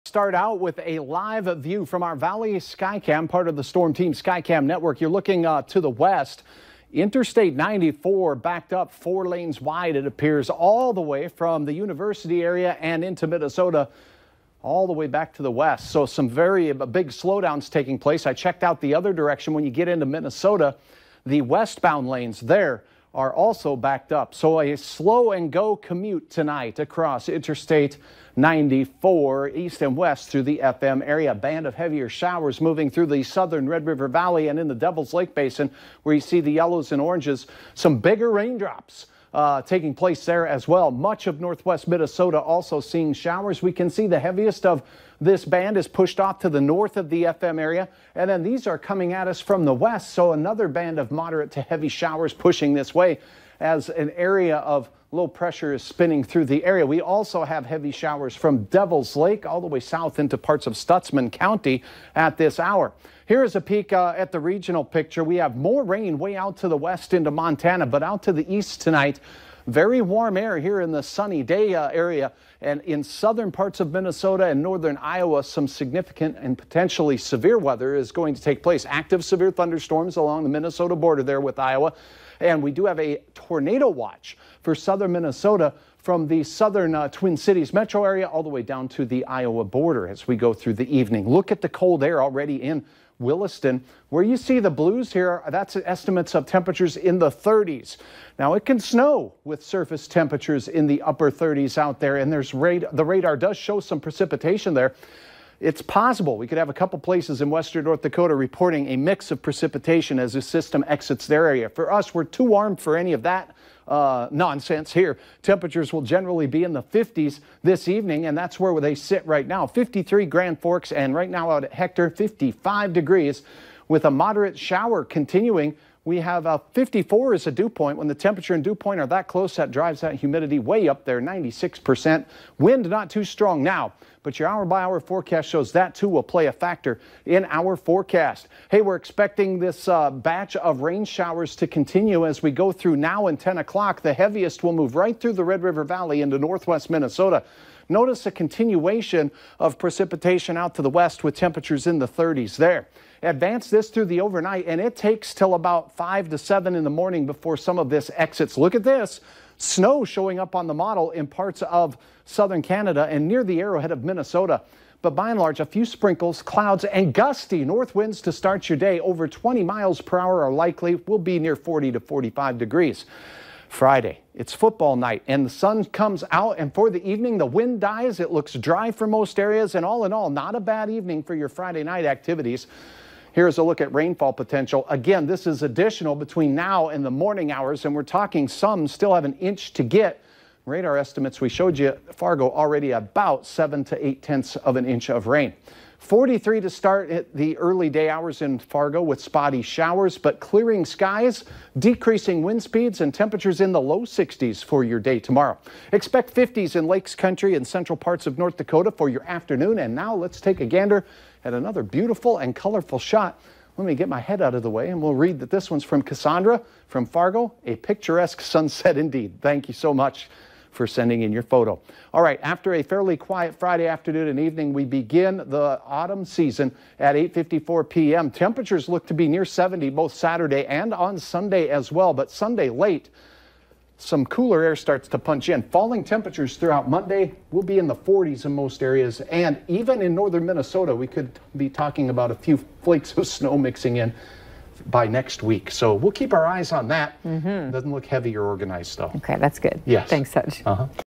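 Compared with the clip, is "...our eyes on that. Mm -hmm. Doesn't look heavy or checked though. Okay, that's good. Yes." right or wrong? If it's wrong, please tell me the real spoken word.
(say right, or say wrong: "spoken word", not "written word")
wrong: "organized", not "checked".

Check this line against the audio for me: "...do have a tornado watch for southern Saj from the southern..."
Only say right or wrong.
wrong.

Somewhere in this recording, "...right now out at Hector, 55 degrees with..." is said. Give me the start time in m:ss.
2:01.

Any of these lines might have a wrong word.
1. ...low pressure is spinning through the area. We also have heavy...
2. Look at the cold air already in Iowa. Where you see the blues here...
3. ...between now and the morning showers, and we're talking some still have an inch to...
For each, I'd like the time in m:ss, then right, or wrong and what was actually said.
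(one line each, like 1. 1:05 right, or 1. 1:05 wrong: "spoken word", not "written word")
1. 0:55 right
2. 1:31 wrong: "Williston", not "Iowa"
3. 3:06 wrong: "hours", not "showers".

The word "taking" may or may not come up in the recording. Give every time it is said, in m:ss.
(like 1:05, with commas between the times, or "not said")
0:17, 0:39.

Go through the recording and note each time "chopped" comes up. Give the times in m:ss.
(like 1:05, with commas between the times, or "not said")
not said.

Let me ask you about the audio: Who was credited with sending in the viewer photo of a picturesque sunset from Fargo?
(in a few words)
Cassandra.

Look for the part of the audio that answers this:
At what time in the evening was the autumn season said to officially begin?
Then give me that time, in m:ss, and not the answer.
3:47.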